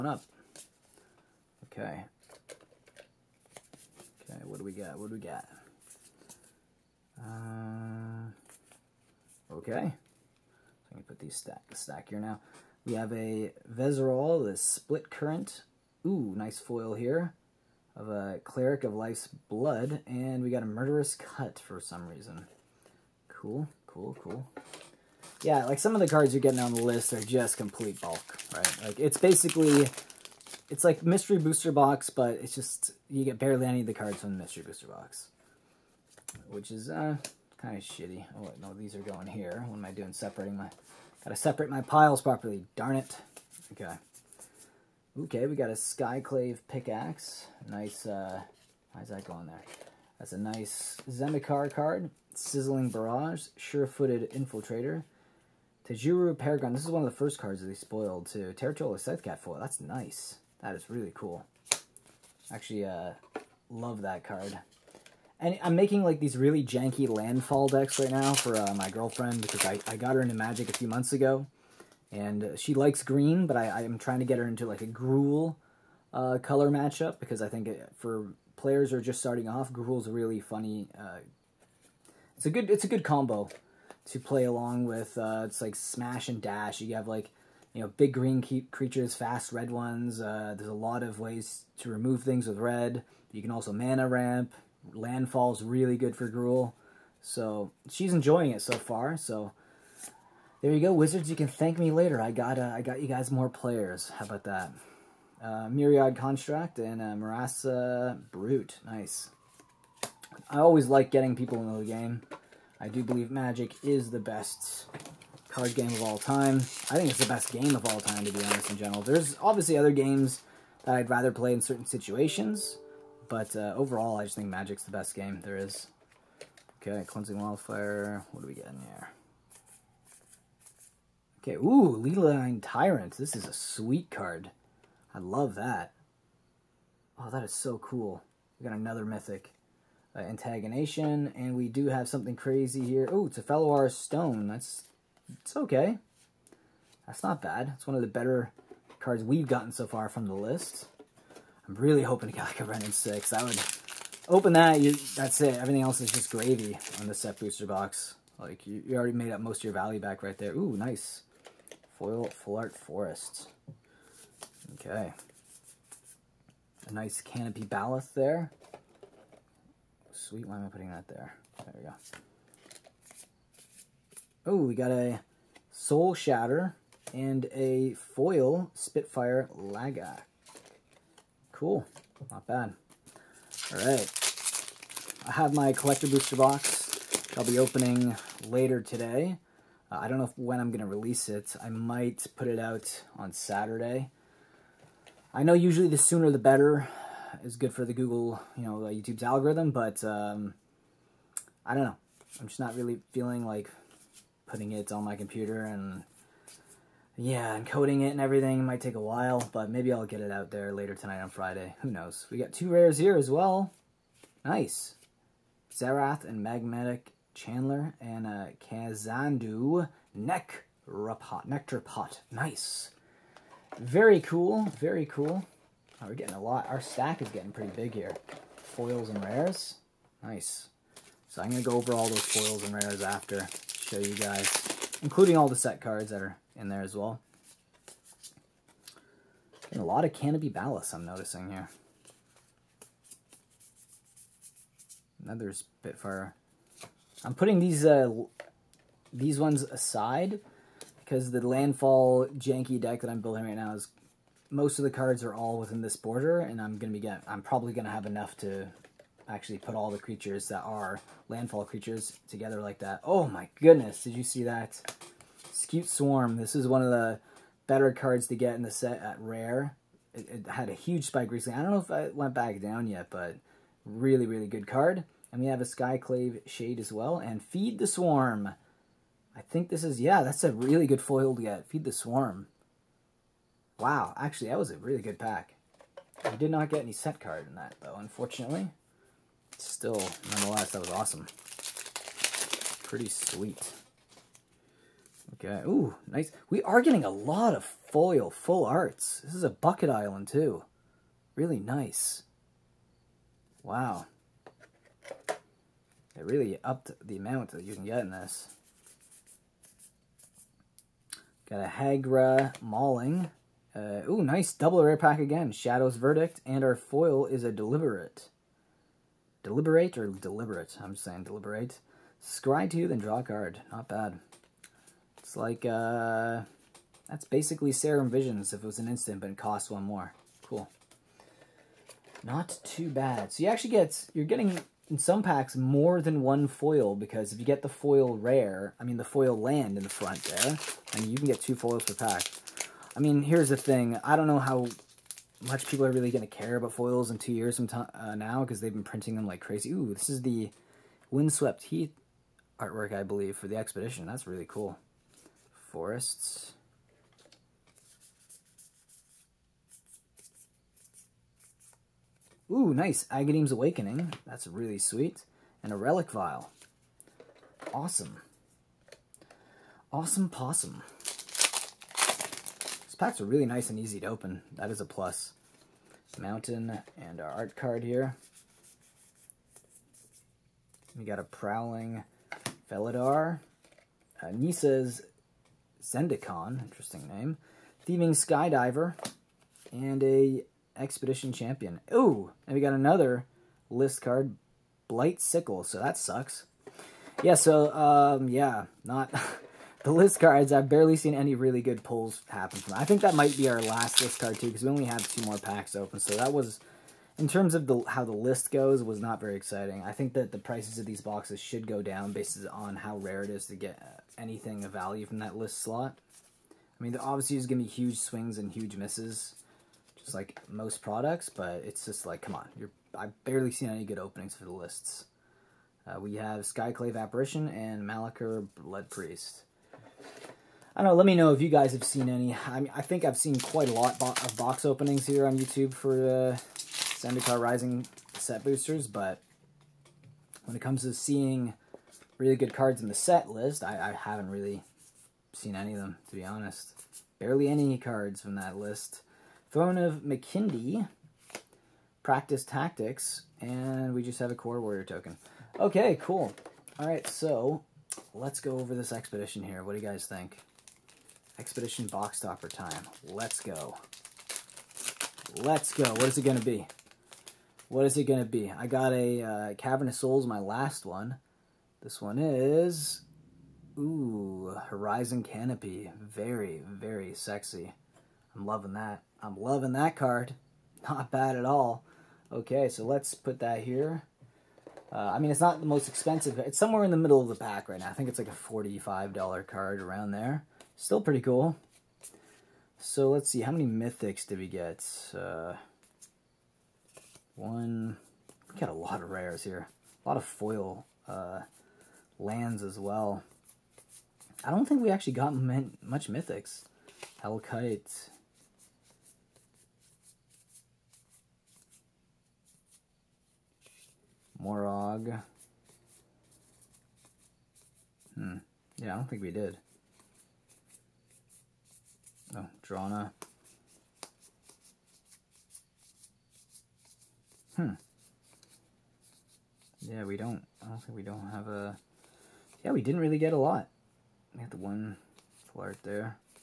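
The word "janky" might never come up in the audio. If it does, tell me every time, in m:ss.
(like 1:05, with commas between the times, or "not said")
1:06, 4:12.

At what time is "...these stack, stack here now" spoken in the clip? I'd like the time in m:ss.
0:11.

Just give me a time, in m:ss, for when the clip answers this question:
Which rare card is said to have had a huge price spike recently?
4:25.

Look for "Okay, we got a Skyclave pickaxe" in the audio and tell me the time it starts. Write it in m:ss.
0:45.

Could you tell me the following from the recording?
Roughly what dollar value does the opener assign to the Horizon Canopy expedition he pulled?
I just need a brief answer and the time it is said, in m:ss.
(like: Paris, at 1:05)
$45, at 8:08.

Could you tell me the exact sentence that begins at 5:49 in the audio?
Ooh, this is the Windswept Heath artwork, I believe, for the expedition.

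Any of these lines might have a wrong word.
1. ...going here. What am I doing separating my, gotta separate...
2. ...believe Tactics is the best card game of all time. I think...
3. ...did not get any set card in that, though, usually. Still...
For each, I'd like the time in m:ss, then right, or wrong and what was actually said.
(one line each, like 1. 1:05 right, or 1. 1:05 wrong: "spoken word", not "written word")
1. 0:38 right
2. 1:53 wrong: "Magic", not "Tactics"
3. 4:46 wrong: "unfortunately", not "usually".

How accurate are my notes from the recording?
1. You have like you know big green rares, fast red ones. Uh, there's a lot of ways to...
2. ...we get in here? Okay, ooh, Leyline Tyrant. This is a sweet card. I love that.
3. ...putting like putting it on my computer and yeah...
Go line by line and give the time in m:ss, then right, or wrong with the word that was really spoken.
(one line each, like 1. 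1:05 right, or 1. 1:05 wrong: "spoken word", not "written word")
1. 1:26 wrong: "creatures", not "rares"
2. 2:08 right
3. 3:23 wrong: "feeling", not "putting".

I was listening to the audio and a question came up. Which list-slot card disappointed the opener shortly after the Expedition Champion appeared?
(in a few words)
Blight Sickle.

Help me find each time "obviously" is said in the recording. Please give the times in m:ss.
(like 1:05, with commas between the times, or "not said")
1:59, 6:56.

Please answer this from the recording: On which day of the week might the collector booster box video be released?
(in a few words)
Saturday.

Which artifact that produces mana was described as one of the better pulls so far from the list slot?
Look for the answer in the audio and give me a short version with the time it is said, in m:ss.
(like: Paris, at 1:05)
Fellwar Stone, at 2:23.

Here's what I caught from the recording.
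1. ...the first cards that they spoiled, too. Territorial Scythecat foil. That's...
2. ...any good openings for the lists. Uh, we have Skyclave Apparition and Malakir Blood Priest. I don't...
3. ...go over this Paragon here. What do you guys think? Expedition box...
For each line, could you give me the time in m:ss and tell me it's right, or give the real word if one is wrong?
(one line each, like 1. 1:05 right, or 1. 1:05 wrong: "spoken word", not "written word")
1. 0:57 right
2. 7:03 right
3. 7:38 wrong: "Expedition", not "Paragon".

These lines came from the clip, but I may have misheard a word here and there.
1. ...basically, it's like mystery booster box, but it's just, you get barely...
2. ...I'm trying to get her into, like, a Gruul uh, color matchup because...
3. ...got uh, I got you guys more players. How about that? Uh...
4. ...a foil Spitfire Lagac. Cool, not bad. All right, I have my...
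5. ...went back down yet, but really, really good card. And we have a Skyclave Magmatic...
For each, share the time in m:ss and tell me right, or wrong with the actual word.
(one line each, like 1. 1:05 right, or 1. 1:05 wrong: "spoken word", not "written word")
1. 0:29 right
2. 1:13 right
3. 1:42 right
4. 2:57 right
5. 4:32 wrong: "Shade", not "Magmatic".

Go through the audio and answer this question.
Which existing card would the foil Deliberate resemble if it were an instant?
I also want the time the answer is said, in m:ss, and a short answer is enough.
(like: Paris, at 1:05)
Serum Visions, at 5:27.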